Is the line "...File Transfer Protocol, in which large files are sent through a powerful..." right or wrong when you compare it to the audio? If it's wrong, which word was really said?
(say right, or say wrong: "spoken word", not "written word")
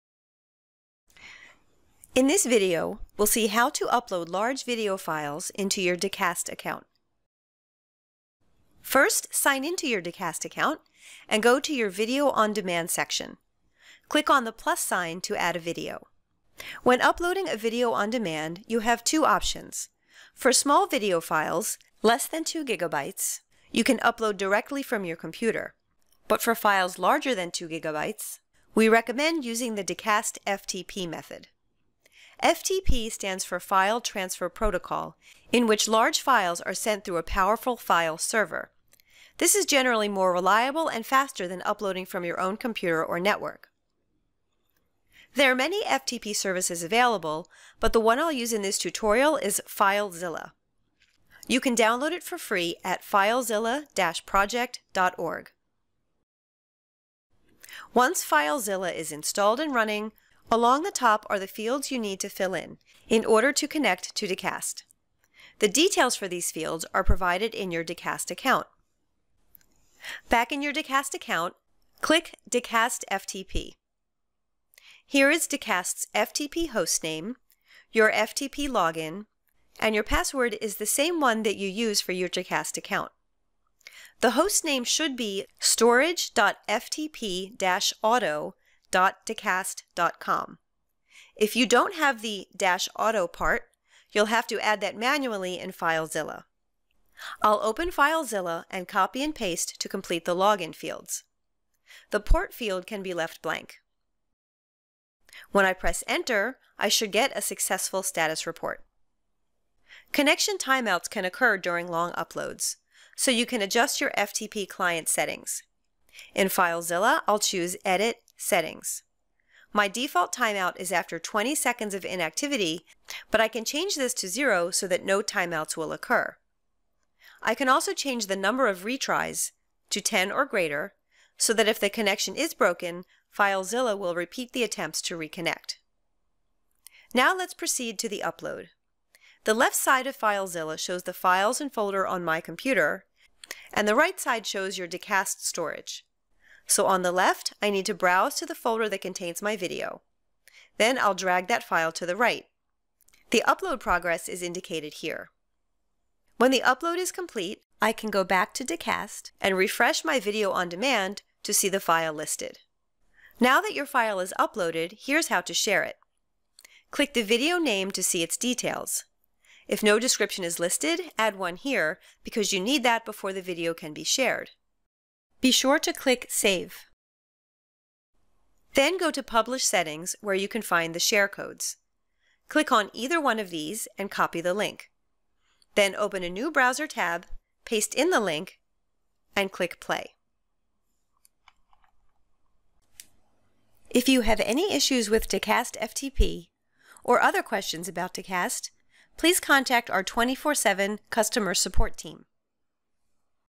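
right.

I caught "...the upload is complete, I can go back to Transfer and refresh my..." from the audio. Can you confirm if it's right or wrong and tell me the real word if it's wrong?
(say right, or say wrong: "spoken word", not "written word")
wrong: "Dacast", not "Transfer".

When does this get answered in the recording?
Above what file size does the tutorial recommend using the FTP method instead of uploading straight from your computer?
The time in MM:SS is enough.
00:26.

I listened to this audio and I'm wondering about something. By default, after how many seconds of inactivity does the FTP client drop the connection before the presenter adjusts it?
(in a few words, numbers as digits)
20.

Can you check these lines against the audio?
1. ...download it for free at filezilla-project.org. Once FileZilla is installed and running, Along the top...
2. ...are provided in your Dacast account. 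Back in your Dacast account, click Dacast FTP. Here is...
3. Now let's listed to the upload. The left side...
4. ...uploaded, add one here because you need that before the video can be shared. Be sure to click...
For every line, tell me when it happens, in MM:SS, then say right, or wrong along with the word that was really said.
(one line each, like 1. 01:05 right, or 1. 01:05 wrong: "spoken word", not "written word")
1. 00:51 right
2. 01:06 right
3. 02:17 wrong: "proceed", not "listed"
4. 02:50 wrong: "listed", not "uploaded".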